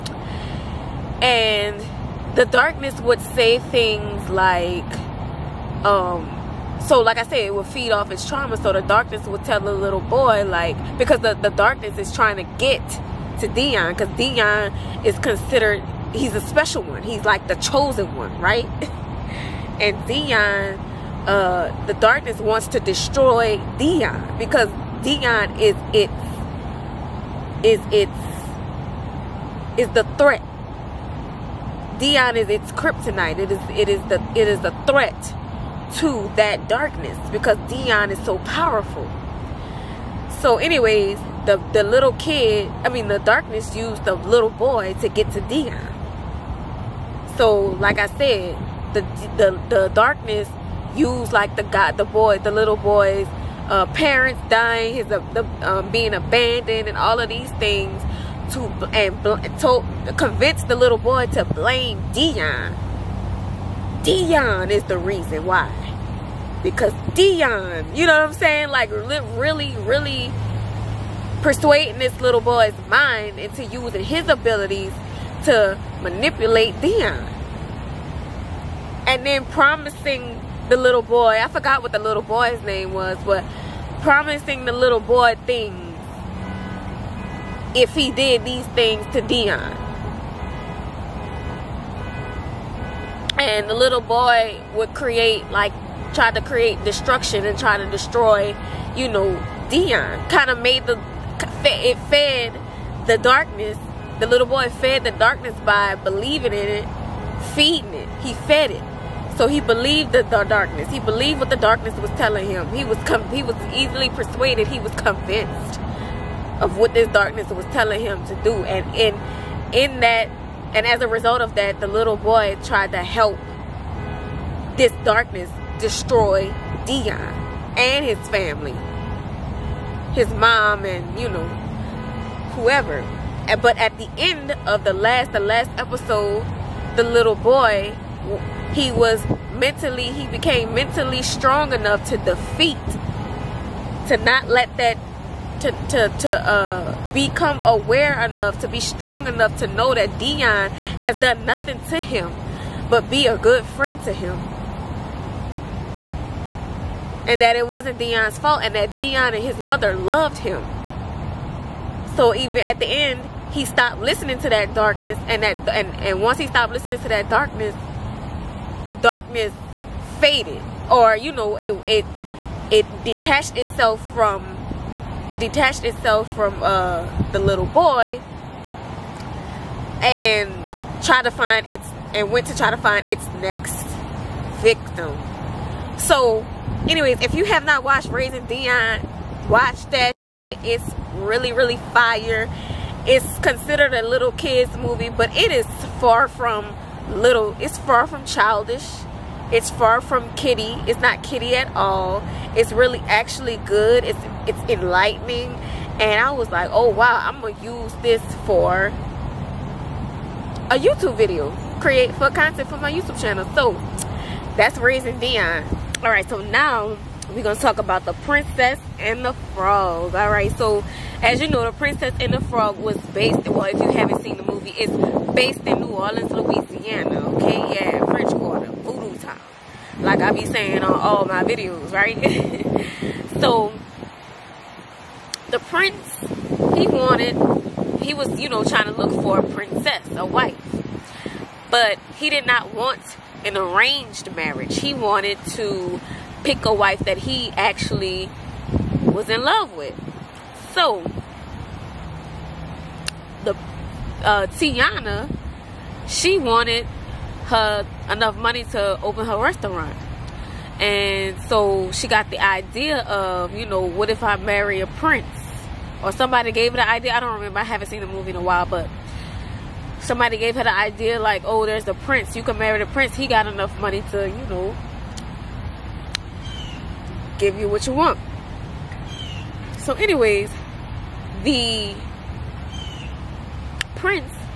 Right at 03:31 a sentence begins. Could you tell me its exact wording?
Create for content for my YouTube channel.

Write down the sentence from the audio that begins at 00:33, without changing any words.
It is it is the it is a threat to that darkness because Dion is so powerful.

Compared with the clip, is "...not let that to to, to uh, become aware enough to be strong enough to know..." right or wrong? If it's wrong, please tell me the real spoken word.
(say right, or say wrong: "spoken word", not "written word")
right.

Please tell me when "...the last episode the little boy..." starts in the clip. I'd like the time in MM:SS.
02:15.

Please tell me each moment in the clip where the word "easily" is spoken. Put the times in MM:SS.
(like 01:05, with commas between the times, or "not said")
01:53.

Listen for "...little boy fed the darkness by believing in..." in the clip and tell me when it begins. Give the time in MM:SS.
01:44.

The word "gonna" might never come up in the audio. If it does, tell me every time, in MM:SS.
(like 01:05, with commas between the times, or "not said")
03:27, 03:37.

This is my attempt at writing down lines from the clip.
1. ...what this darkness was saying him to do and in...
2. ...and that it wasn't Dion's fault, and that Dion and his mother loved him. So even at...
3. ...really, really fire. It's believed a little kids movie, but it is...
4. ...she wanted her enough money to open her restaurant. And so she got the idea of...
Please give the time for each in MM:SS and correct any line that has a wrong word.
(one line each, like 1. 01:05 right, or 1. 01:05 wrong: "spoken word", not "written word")
1. 01:56 wrong: "telling", not "saying"
2. 02:37 right
3. 03:11 wrong: "considered", not "believed"
4. 04:16 right.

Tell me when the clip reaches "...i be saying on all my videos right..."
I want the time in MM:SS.
03:50.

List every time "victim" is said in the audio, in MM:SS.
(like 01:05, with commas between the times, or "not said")
03:04.